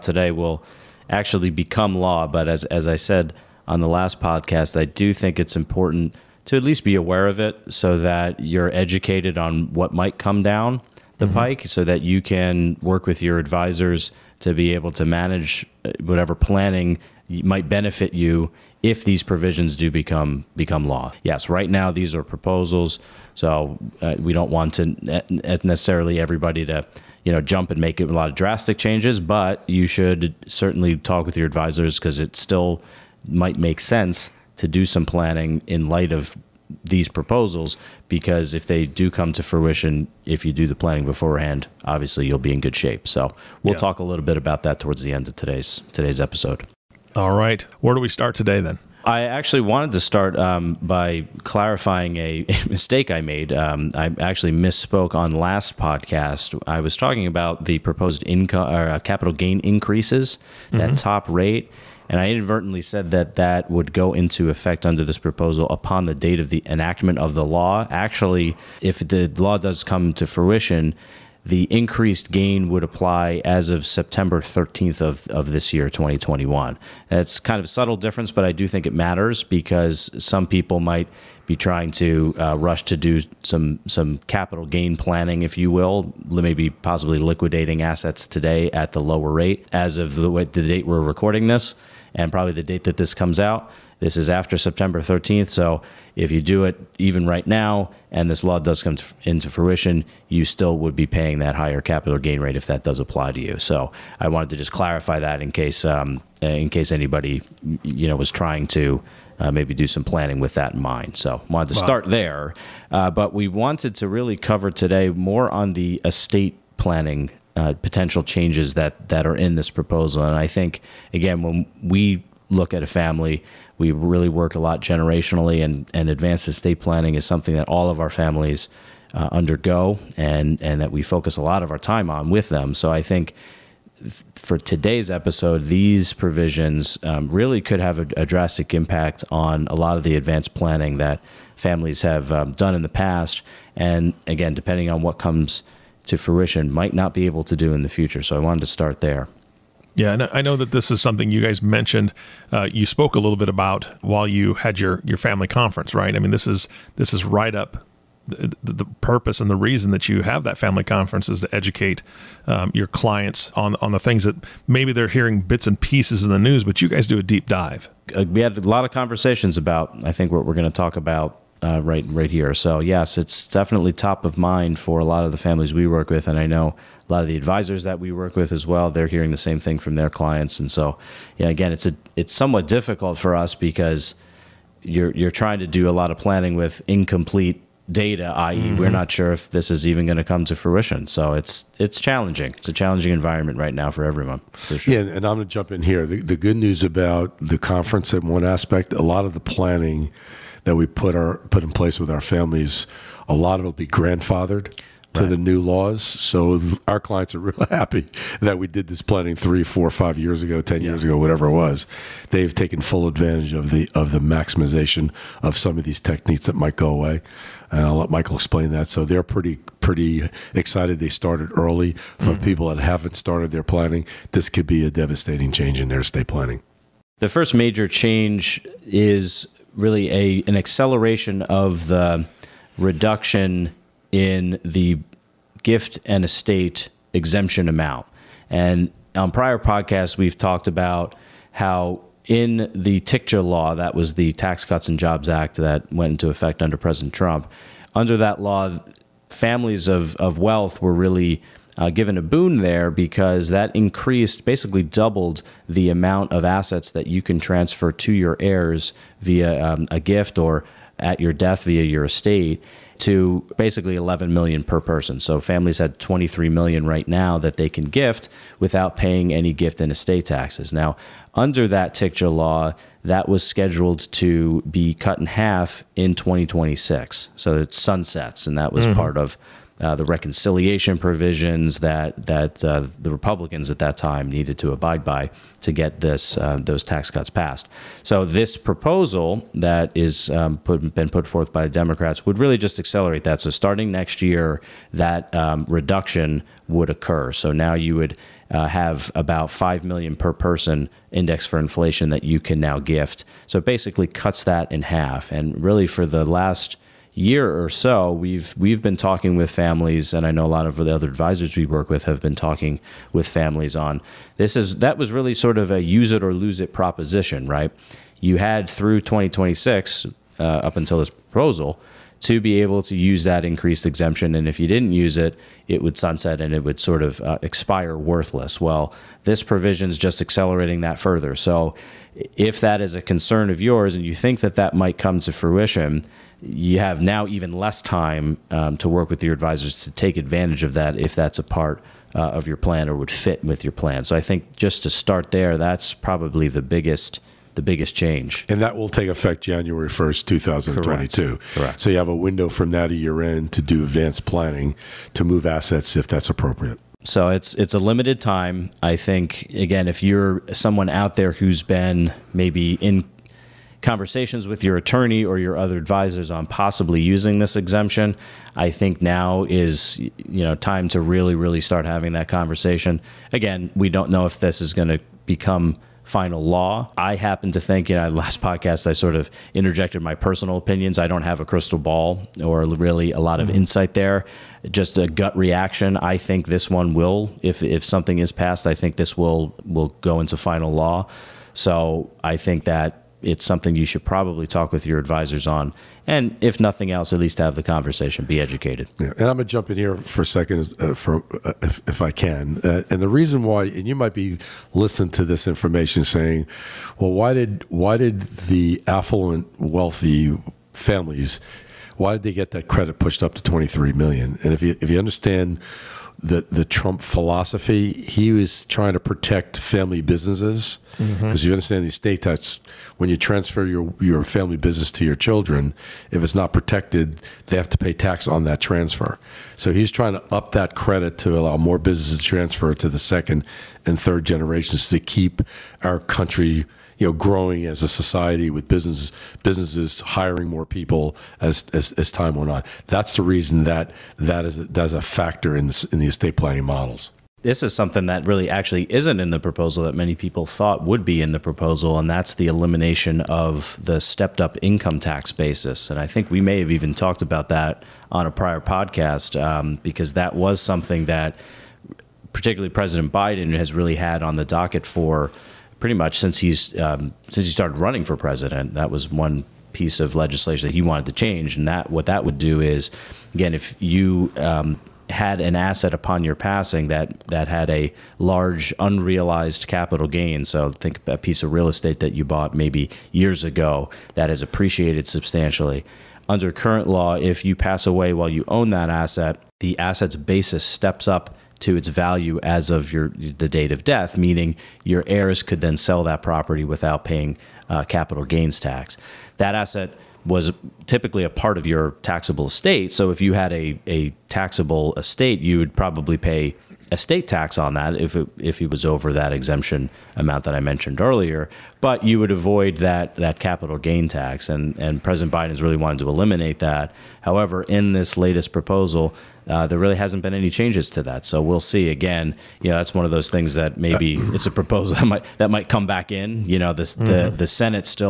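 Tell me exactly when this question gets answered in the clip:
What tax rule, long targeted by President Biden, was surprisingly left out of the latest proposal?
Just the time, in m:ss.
7:34.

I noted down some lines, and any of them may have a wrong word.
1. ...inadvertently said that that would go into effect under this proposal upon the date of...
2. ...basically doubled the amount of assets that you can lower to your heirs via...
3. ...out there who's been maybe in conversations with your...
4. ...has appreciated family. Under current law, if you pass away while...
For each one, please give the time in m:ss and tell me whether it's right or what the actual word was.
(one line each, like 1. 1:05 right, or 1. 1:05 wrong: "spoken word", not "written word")
1. 1:02 right
2. 4:14 wrong: "transfer", not "lower"
3. 6:00 right
4. 8:04 wrong: "substantially", not "family".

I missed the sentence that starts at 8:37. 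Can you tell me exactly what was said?
However, in this latest proposal, uh, there really hasn't been any changes to that.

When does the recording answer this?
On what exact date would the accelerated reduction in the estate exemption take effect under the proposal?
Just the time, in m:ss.
5:49.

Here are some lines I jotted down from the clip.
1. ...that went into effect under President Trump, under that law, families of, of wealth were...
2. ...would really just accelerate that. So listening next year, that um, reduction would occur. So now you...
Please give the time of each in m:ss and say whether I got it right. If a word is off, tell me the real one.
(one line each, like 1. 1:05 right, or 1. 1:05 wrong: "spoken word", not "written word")
1. 4:05 right
2. 4:52 wrong: "starting", not "listening".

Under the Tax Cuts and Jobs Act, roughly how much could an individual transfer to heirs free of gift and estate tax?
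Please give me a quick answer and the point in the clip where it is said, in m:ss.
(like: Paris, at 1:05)
11 million, at 4:23.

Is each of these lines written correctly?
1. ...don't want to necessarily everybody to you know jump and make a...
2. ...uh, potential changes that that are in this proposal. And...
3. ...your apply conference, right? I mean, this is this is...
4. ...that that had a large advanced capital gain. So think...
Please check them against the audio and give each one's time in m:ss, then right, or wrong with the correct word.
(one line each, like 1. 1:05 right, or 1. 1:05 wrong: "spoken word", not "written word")
1. 0:24 right
2. 1:57 right
3. 2:35 wrong: "family", not "apply"
4. 7:56 wrong: "unrealized", not "advanced".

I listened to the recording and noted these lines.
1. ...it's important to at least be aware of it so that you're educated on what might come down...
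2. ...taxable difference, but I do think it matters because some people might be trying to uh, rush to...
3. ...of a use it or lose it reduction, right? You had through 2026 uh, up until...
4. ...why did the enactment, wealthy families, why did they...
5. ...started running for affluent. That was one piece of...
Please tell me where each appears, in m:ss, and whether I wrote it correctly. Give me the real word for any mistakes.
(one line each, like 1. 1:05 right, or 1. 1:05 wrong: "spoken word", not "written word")
1. 0:05 right
2. 1:17 wrong: "subtle", not "taxable"
3. 5:15 wrong: "proposition", not "reduction"
4. 6:47 wrong: "affluent", not "enactment"
5. 7:47 wrong: "president", not "affluent".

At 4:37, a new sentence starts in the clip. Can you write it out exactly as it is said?
So it sunsets, and that was mm -hmm.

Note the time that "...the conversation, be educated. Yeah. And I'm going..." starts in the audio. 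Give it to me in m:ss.
6:37.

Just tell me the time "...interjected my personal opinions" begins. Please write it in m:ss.
6:19.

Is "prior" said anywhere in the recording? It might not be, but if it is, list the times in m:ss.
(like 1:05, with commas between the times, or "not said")
3:59, 7:38.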